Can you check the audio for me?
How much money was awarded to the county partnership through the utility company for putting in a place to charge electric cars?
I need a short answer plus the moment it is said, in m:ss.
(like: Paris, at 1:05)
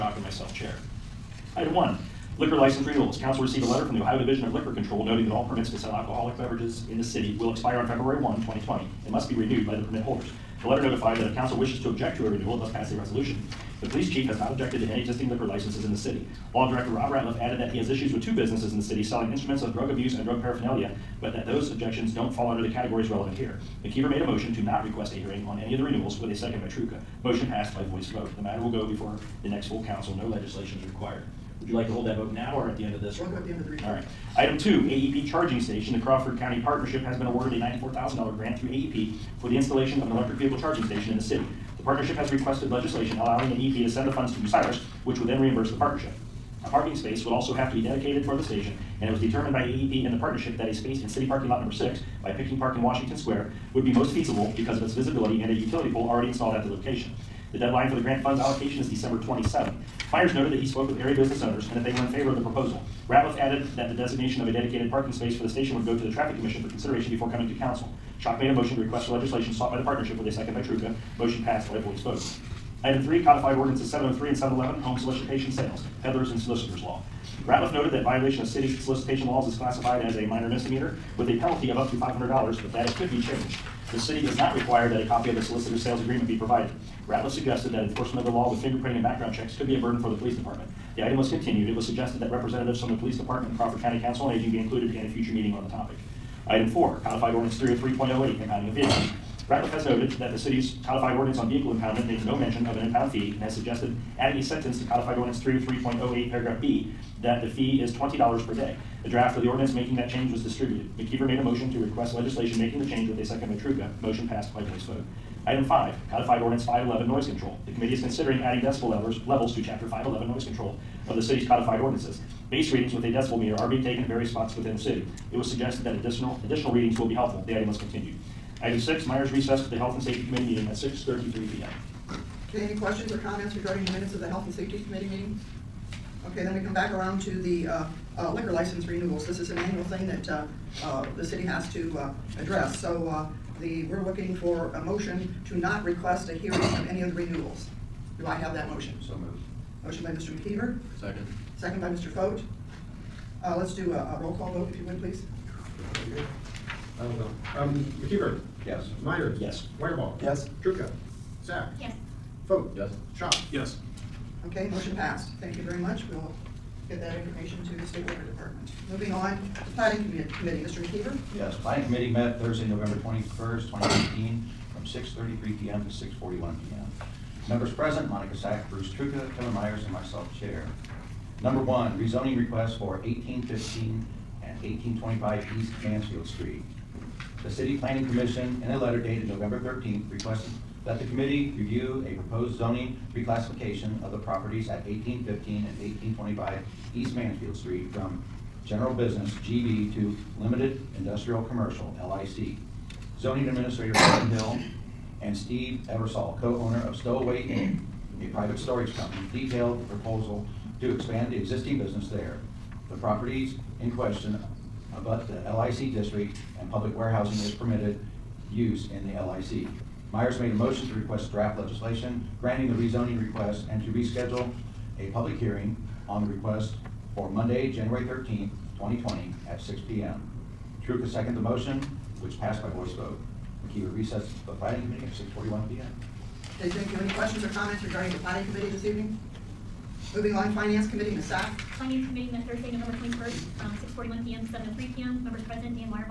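$94,000, at 0:37.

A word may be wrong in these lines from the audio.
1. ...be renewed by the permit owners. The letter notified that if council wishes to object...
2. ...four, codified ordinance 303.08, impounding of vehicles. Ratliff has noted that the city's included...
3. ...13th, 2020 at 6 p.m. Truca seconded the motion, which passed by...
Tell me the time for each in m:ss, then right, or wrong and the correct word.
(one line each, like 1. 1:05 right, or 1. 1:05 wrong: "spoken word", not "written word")
1. 0:09 wrong: "holders", not "owners"
2. 1:36 wrong: "codified", not "included"
3. 3:48 right.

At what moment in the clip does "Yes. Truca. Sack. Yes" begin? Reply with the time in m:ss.
2:40.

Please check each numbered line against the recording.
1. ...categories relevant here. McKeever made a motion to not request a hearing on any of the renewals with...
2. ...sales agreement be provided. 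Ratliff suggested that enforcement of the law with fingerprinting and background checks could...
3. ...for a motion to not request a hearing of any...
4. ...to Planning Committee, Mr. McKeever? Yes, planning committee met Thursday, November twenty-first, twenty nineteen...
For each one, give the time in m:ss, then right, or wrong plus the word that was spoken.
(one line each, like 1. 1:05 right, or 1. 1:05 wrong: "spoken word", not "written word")
1. 0:22 right
2. 1:25 right
3. 2:24 right
4. 2:49 right.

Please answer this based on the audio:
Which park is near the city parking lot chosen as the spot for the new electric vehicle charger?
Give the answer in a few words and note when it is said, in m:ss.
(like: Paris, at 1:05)
Picking Park, at 0:52.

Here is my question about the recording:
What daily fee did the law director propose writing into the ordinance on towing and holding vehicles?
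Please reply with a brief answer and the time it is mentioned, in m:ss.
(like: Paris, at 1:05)
$20, at 1:47.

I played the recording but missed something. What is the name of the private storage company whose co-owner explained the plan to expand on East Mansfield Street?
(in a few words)
Stowaway Inc.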